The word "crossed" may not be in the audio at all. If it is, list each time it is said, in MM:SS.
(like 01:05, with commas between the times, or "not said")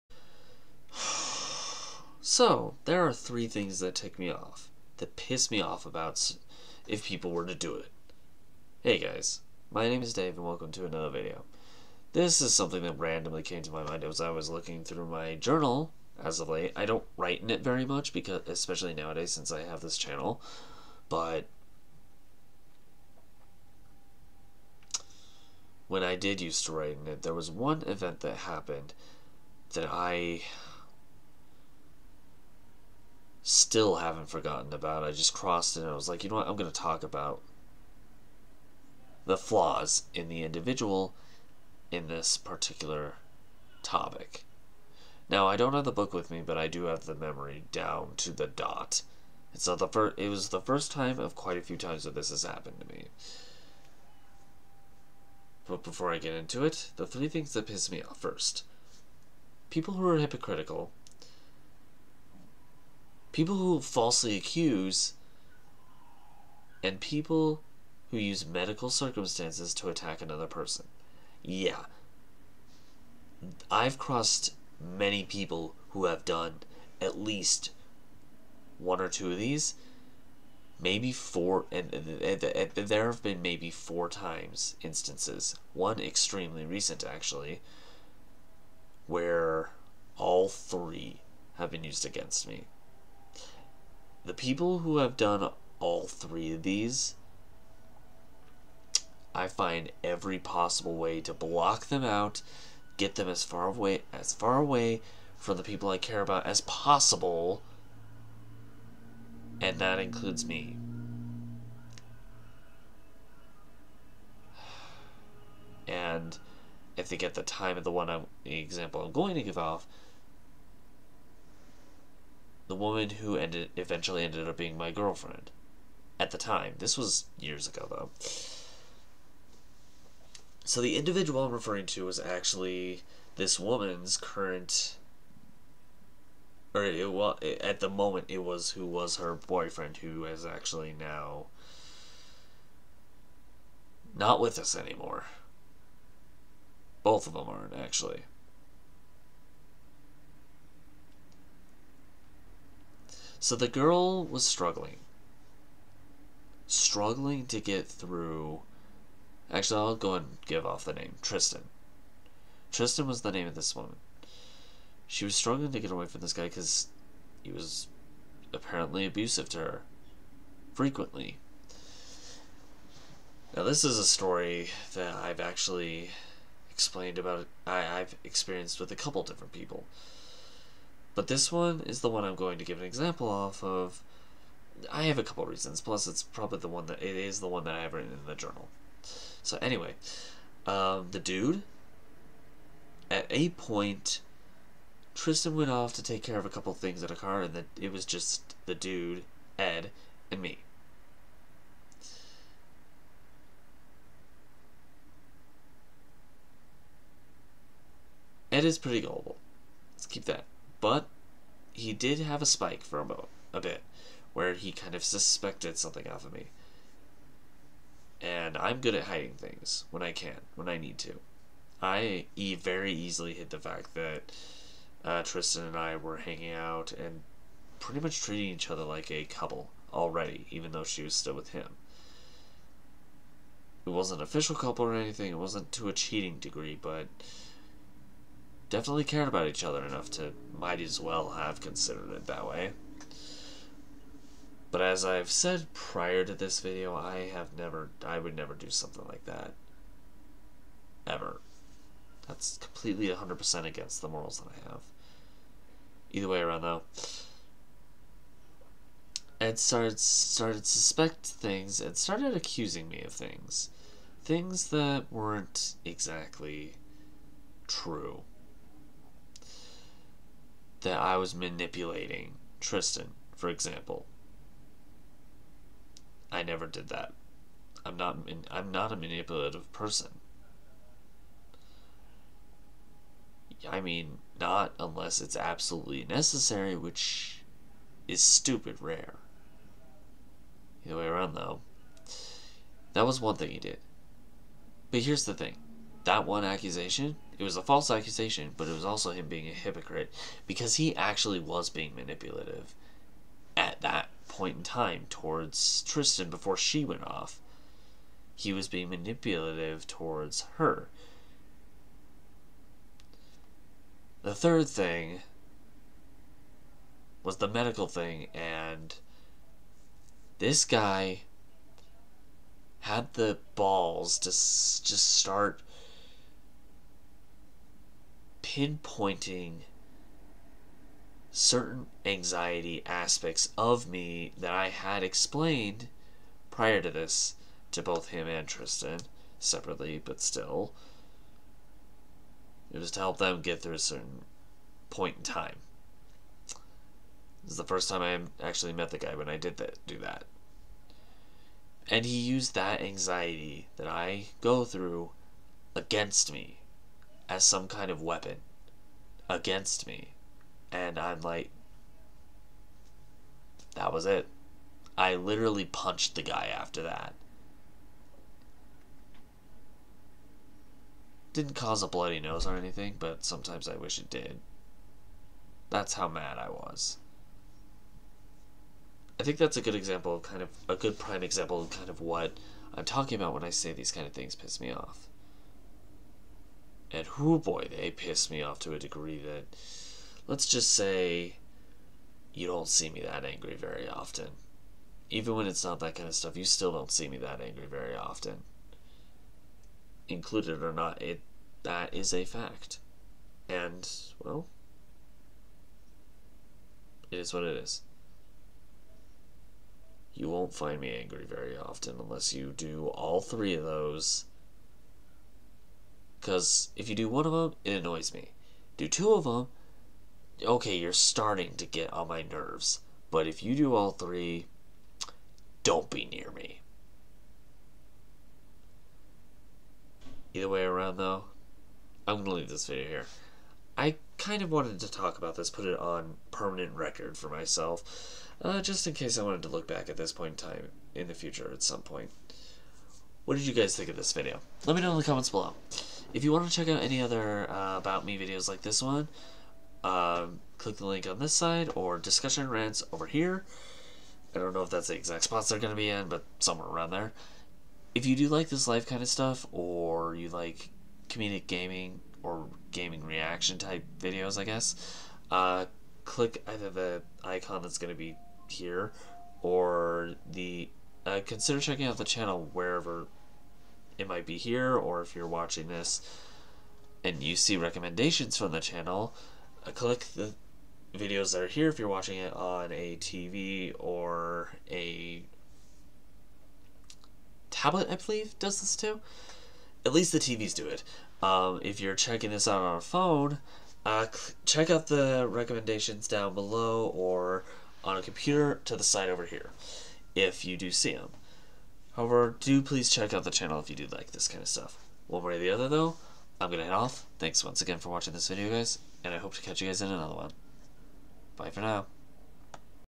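00:35, 01:13.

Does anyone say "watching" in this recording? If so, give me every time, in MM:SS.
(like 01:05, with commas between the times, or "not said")
07:55, 08:01, 08:27.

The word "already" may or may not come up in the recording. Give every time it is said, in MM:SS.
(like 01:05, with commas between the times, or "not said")
03:49.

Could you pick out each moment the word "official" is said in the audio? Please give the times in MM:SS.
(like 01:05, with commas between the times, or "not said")
03:54.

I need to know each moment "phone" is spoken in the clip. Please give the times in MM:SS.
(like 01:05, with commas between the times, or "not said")
08:12.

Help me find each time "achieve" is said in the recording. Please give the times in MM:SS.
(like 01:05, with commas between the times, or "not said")
not said.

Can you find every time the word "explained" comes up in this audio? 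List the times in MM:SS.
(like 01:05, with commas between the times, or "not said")
02:56, 05:35.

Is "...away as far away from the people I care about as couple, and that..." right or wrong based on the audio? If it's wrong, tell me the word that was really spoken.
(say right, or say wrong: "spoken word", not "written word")
wrong: "possible", not "couple".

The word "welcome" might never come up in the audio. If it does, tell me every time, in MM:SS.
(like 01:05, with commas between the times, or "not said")
00:10.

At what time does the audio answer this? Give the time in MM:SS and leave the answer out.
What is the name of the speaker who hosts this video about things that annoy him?
00:10.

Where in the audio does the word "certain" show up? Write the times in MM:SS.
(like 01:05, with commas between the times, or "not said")
05:31, 05:43.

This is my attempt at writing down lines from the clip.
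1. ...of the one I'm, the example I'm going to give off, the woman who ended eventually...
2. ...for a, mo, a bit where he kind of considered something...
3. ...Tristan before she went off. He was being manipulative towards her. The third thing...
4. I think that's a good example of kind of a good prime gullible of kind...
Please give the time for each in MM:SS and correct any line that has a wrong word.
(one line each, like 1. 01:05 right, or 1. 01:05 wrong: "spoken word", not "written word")
1. 01:57 right
2. 03:32 wrong: "suspected", not "considered"
3. 05:05 right
4. 06:19 wrong: "example", not "gullible".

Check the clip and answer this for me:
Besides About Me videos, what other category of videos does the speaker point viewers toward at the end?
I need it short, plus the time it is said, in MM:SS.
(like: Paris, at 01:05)
discussion rants, at 07:31.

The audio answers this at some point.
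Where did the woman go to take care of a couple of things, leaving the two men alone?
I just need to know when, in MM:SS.
03:17.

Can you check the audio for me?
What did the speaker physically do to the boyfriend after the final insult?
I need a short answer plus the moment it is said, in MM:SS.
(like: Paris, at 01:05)
punched the guy, at 06:05.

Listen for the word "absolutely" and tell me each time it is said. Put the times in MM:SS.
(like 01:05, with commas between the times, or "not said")
04:45.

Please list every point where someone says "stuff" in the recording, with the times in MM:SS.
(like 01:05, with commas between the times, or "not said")
06:36, 07:39, 08:24.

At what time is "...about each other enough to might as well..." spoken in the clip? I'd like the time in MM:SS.
03:59.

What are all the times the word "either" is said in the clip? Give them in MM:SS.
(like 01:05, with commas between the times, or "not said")
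04:16, 04:50, 07:10, 07:46.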